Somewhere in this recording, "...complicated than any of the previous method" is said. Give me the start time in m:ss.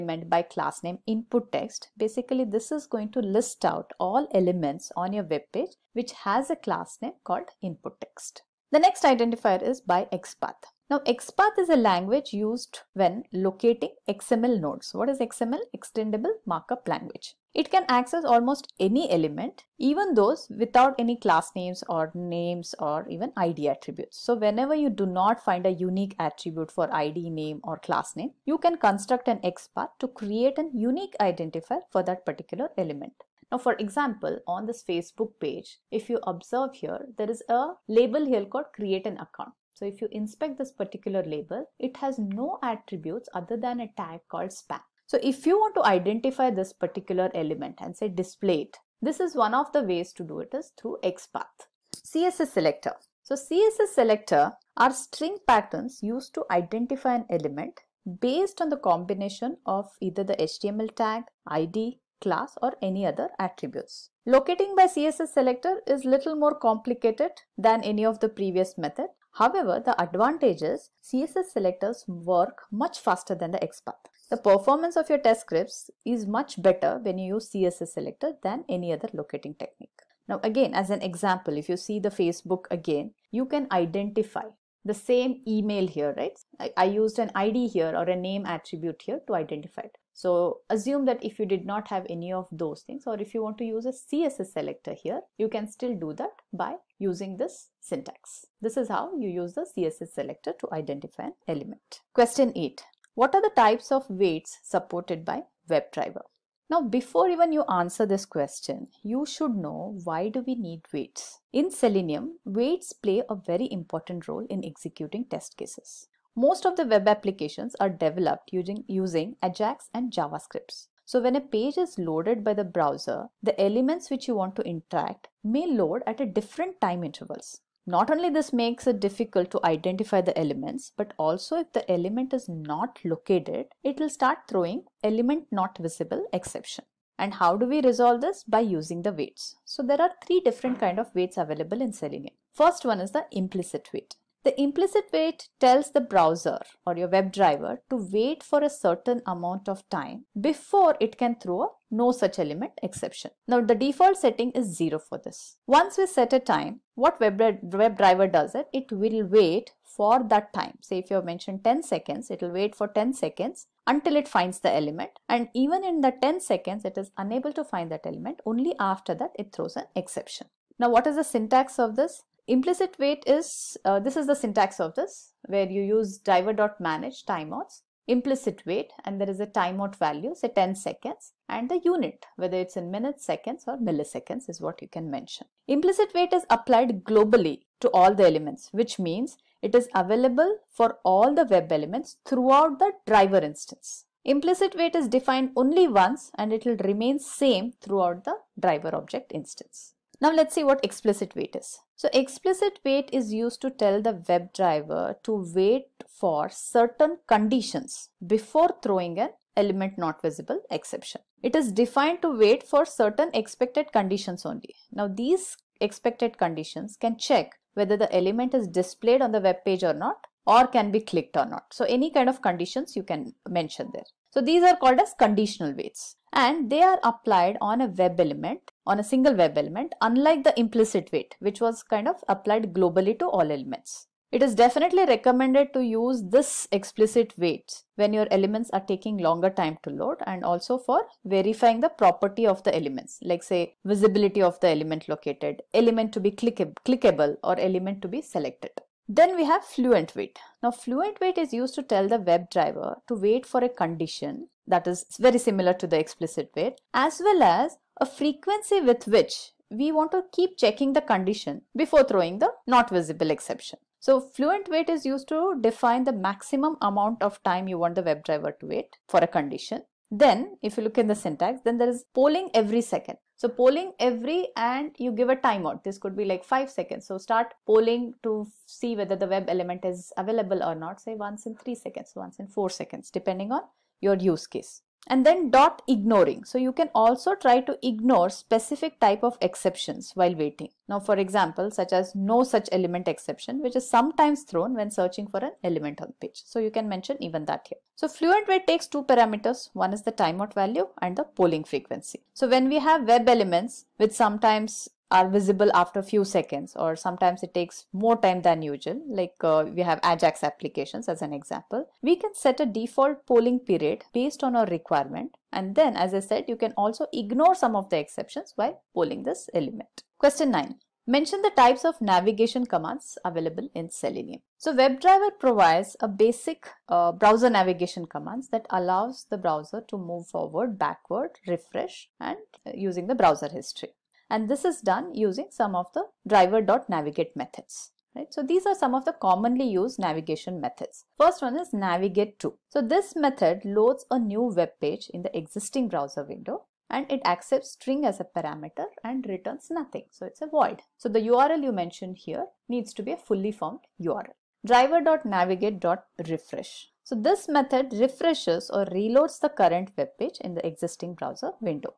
1:06.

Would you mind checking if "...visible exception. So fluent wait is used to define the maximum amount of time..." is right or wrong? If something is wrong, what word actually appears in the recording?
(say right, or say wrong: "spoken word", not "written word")
right.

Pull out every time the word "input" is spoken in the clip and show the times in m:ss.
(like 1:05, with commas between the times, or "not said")
0:01, 0:07.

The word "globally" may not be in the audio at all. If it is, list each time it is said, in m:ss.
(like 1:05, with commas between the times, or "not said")
3:07, 3:52.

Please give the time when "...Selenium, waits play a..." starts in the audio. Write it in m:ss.
1:51.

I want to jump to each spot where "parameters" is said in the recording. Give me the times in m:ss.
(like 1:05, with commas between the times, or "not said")
4:59, 5:48.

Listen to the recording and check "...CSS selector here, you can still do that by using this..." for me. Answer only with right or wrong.
right.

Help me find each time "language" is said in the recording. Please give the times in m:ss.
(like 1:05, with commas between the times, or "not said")
0:11, 0:16.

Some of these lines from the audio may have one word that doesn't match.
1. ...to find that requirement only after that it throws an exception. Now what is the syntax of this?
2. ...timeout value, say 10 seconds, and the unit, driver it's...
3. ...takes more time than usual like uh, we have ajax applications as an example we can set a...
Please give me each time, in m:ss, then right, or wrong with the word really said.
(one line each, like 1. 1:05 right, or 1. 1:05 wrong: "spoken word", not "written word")
1. 2:47 wrong: "element", not "requirement"
2. 2:59 wrong: "whether", not "driver"
3. 5:07 right.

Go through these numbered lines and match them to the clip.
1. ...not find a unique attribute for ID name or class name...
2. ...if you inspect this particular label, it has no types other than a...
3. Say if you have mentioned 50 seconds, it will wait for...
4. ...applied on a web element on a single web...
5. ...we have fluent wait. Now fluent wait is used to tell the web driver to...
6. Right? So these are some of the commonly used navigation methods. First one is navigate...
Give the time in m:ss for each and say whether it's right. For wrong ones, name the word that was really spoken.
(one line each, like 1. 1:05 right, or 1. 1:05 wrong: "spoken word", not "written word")
1. 0:25 right
2. 0:39 wrong: "attributes", not "types"
3. 2:40 wrong: "10", not "50"
4. 3:47 right
5. 4:09 right
6. 5:38 right.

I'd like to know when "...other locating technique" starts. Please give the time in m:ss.
1:18.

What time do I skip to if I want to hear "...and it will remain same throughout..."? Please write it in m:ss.
3:16.